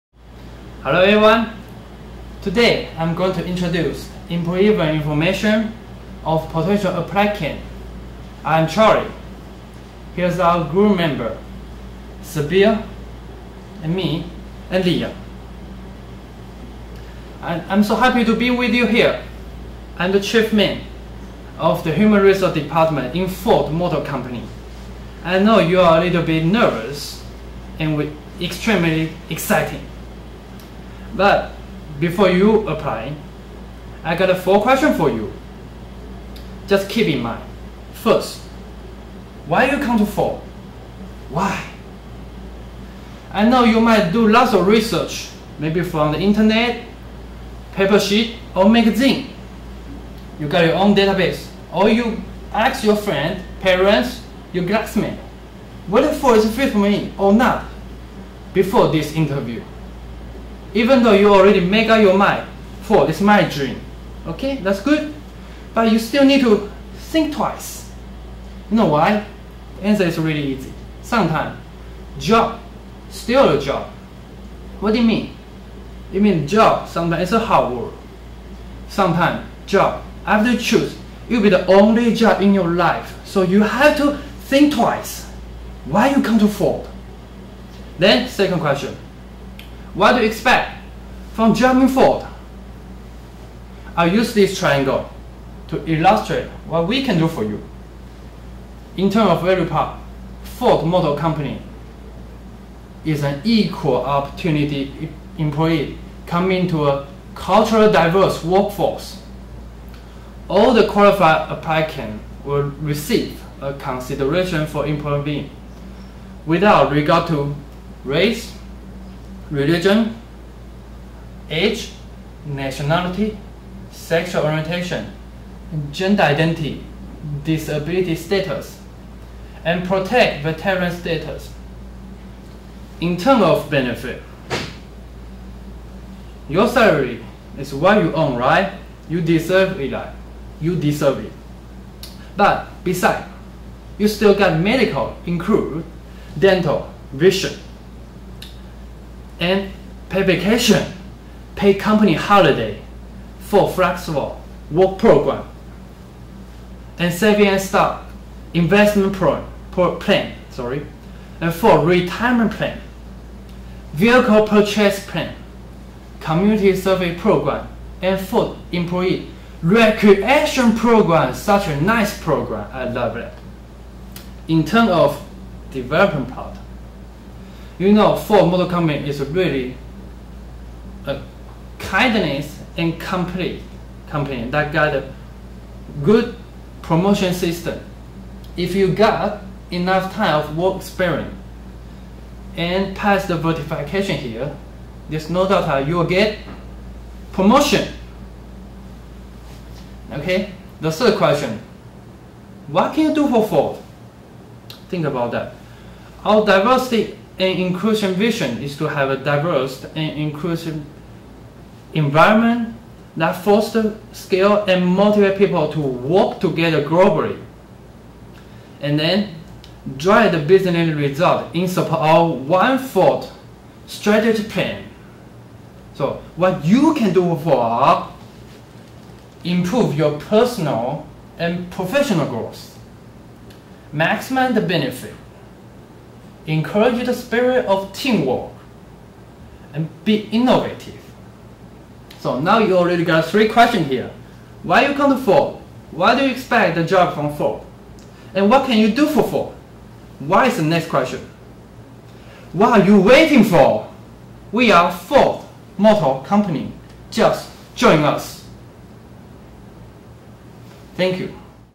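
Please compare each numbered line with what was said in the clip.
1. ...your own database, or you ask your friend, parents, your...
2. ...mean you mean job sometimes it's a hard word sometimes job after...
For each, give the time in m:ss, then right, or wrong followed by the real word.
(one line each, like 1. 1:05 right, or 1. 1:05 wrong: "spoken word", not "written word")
1. 0:50 right
2. 1:15 right.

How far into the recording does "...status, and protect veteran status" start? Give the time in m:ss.
2:08.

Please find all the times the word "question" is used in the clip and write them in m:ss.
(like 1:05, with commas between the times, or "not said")
0:34, 1:28, 3:21, 4:03, 4:10.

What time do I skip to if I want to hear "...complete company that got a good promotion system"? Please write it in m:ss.
3:02.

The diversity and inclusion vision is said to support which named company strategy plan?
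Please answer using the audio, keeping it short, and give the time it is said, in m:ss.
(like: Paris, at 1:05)
One Ford, at 3:42.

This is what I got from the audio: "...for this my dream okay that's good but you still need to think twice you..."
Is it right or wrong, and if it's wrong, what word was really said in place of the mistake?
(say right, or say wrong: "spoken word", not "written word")
right.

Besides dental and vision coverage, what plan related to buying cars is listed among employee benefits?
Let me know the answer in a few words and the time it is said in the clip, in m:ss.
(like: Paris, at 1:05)
Vehicle purchase plan, at 2:43.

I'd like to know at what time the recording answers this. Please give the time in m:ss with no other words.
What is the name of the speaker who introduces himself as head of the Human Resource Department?
0:08.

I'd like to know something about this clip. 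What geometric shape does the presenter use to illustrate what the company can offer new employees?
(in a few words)
Triangle.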